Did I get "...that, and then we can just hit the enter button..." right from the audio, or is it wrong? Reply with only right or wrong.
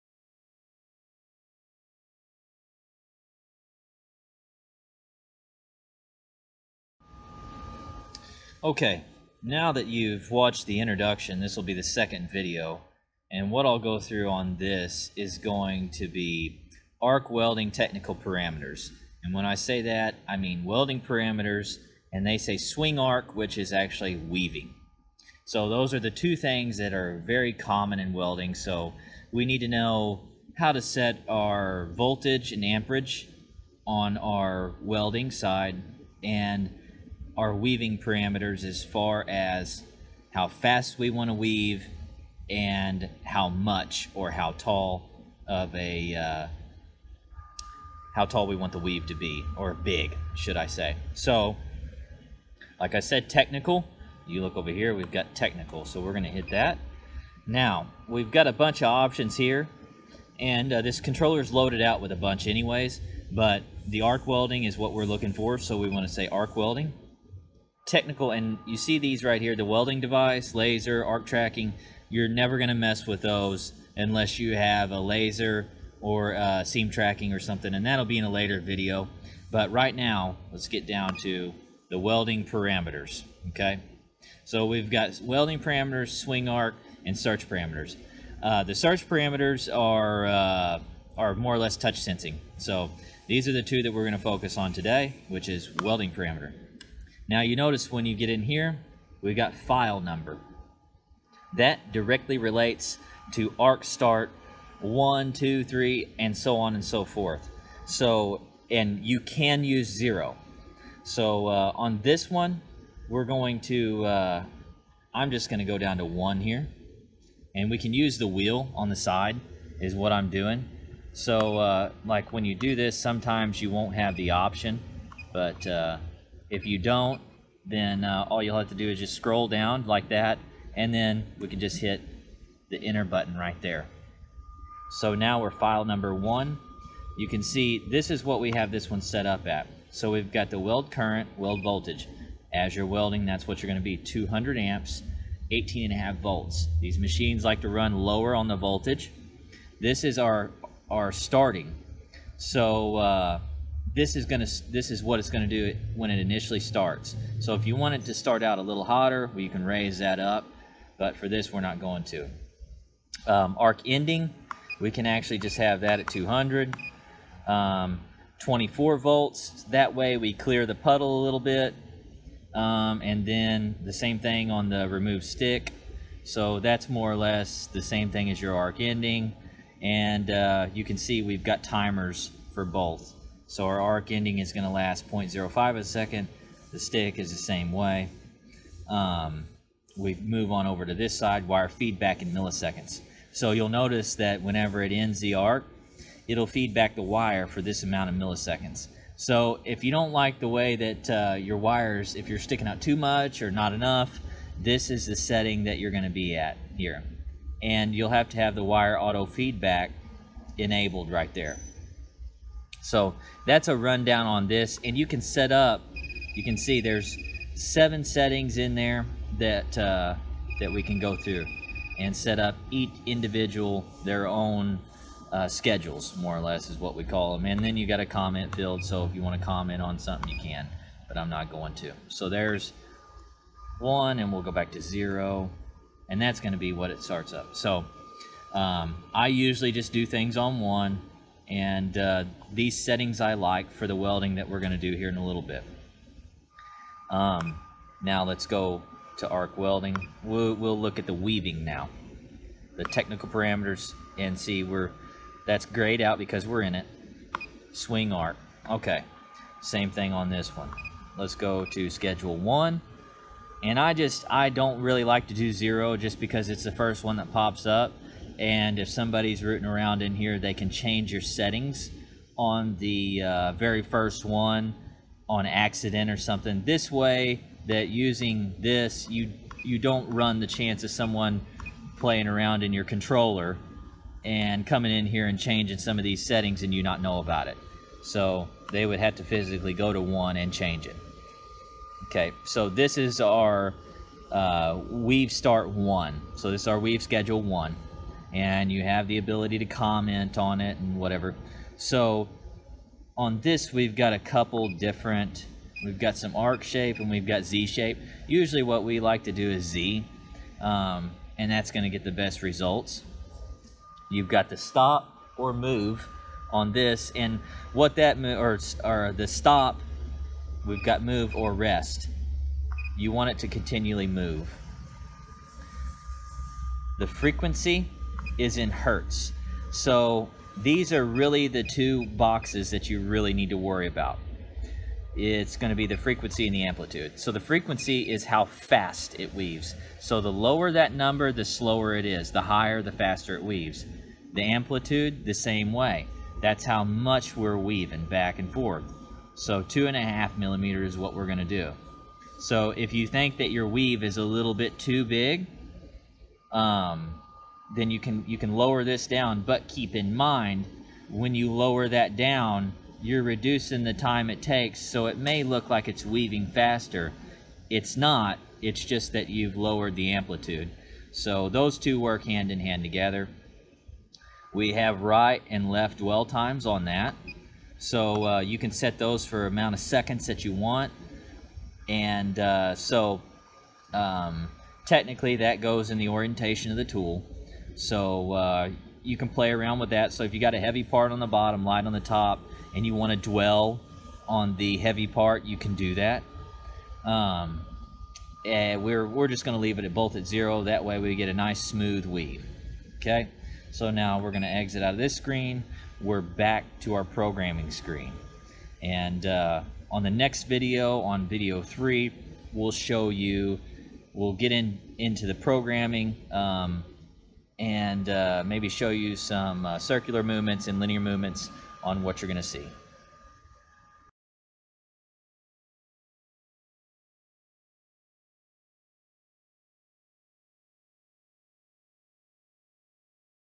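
right.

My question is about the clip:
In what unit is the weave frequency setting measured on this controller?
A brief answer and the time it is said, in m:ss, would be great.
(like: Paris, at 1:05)
hertz, at 5:28.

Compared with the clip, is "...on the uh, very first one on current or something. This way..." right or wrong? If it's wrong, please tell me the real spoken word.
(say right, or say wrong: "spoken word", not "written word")
wrong: "accident", not "current".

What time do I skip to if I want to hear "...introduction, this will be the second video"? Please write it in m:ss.
0:10.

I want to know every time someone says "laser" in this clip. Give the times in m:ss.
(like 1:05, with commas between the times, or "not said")
1:10, 1:14.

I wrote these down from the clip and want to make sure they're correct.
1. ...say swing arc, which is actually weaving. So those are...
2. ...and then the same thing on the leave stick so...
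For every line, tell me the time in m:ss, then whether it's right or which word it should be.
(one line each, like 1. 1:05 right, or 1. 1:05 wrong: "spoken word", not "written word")
1. 0:22 right
2. 2:53 wrong: "remove", not "leave".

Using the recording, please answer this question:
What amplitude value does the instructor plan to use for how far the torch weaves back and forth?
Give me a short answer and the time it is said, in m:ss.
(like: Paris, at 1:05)
2.5 millimeters, at 5:49.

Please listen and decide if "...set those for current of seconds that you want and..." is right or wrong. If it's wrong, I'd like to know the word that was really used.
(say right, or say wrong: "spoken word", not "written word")
wrong: "amount", not "current".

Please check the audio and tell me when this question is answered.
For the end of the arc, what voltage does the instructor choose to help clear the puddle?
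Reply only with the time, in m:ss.
2:48.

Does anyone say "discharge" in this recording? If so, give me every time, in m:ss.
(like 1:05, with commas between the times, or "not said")
not said.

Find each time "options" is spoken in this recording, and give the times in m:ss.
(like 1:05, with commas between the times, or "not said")
0:58, 2:04.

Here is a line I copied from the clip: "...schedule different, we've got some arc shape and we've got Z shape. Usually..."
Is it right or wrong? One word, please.
wrong.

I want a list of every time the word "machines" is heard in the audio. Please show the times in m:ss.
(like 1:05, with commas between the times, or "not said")
2:26.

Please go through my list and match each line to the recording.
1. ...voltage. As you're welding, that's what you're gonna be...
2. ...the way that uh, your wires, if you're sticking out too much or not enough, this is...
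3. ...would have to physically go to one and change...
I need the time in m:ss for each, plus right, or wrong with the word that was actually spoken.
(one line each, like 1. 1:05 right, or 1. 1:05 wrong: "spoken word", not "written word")
1. 2:21 right
2. 3:20 right
3. 4:48 right.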